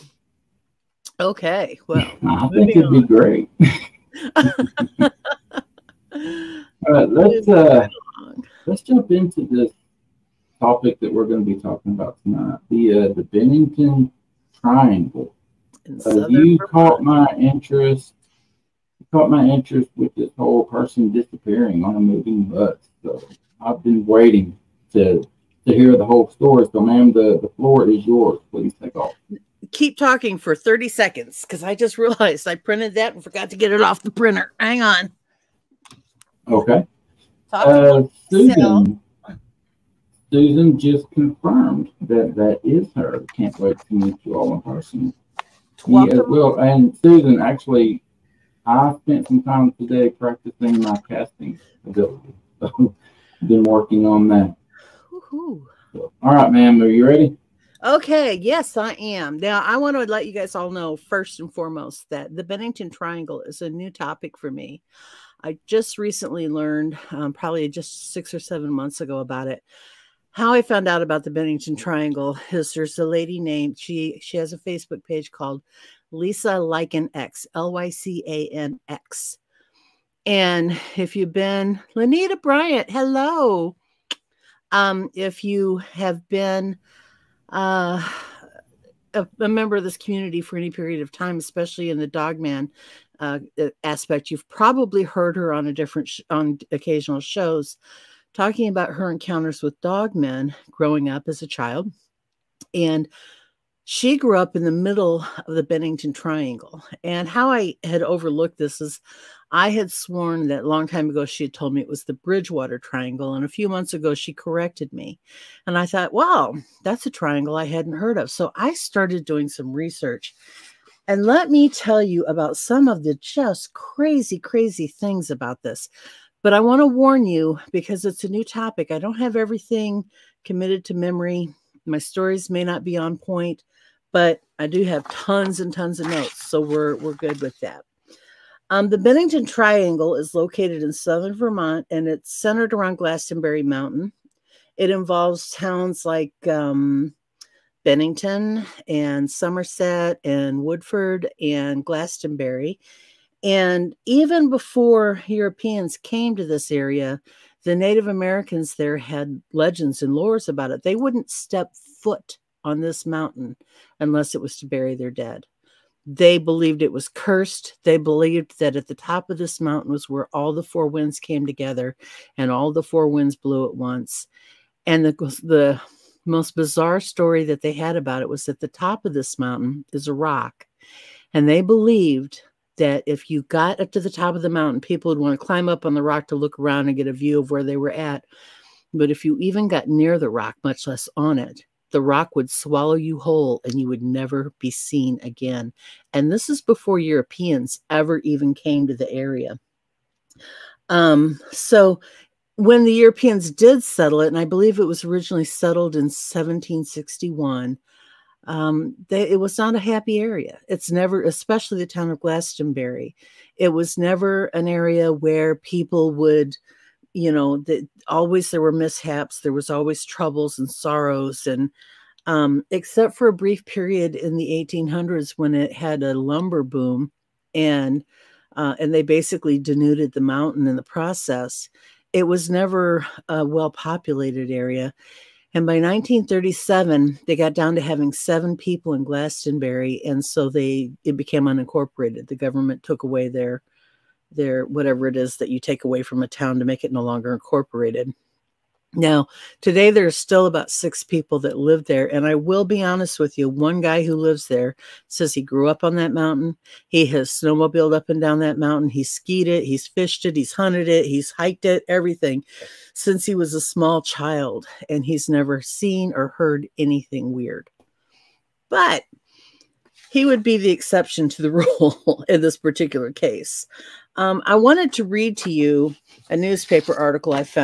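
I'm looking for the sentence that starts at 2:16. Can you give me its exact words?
So we're, we're good with that.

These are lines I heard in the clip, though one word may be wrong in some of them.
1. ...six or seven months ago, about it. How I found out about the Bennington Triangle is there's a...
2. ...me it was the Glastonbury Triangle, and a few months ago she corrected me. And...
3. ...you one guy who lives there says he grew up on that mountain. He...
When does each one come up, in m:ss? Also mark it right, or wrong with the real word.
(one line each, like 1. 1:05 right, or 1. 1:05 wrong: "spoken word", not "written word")
1. 1:08 right
2. 1:51 wrong: "Bridgewater", not "Glastonbury"
3. 4:13 right.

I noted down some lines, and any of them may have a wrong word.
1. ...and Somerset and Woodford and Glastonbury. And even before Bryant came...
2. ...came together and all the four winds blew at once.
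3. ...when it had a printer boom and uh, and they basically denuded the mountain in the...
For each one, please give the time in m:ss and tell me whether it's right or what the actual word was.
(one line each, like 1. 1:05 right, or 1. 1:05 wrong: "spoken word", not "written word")
1. 2:28 wrong: "Europeans", not "Bryant"
2. 2:51 right
3. 3:45 wrong: "lumber", not "printer".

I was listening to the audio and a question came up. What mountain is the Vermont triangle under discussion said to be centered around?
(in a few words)
Glastonbury Mountain.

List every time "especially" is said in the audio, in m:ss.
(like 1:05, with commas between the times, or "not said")
1:31, 3:31.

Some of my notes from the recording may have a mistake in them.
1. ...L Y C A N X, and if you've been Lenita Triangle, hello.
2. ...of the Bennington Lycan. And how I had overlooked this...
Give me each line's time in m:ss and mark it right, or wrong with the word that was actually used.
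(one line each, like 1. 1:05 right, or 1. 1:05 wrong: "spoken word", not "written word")
1. 1:17 wrong: "Bryant", not "Triangle"
2. 1:45 wrong: "Triangle", not "Lycan".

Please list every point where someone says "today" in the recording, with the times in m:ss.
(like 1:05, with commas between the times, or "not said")
0:49, 4:09.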